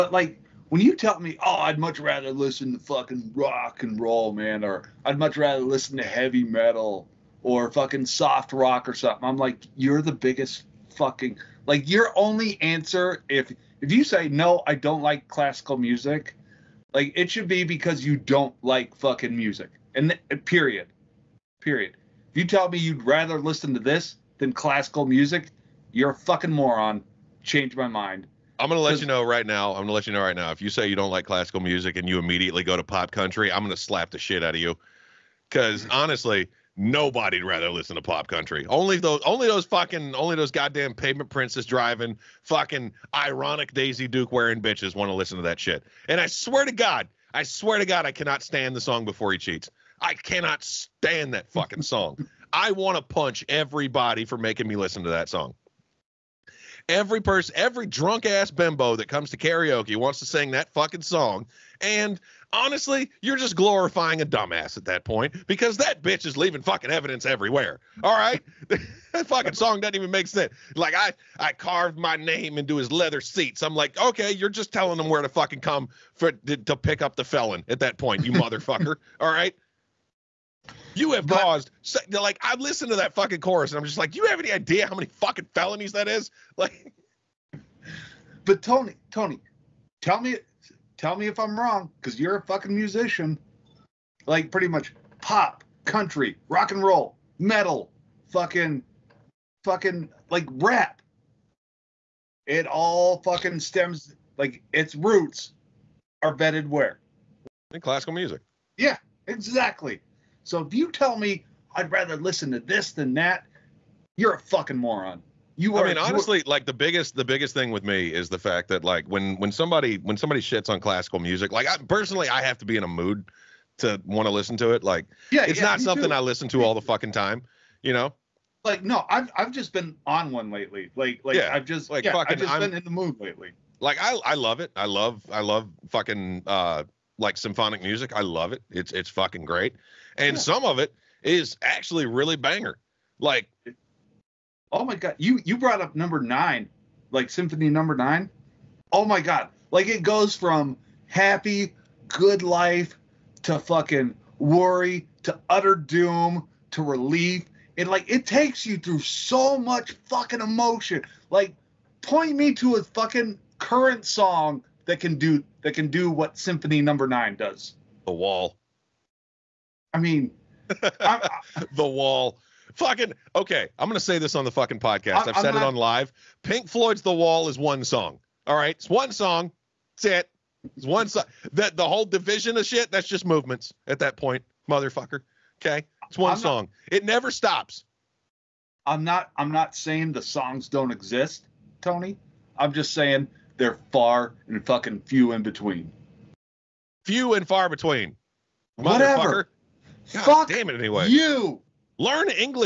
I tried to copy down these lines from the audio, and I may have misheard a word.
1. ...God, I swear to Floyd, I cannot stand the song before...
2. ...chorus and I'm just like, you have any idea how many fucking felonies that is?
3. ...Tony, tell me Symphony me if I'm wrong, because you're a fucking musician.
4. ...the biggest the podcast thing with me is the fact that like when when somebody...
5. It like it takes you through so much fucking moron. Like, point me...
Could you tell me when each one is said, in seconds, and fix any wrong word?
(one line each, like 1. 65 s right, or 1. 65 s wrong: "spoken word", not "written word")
1. 46 s wrong: "God", not "Floyd"
2. 83 s right
3. 89 s wrong: "Tell", not "Symphony"
4. 116 s wrong: "biggest", not "podcast"
5. 157 s wrong: "emotion", not "moron".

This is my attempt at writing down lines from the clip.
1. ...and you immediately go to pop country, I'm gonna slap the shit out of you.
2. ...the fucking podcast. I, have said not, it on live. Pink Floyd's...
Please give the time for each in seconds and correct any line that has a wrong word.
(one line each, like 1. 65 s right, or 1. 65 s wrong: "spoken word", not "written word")
1. 31 s right
2. 174 s right.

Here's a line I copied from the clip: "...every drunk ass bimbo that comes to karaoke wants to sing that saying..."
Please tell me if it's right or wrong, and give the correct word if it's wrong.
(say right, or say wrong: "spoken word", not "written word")
wrong: "fucking", not "saying".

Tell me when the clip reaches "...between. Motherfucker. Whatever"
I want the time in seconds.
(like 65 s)
197 s.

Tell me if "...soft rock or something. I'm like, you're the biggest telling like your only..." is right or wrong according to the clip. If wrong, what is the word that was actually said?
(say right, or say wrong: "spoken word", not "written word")
wrong: "fucking", not "telling".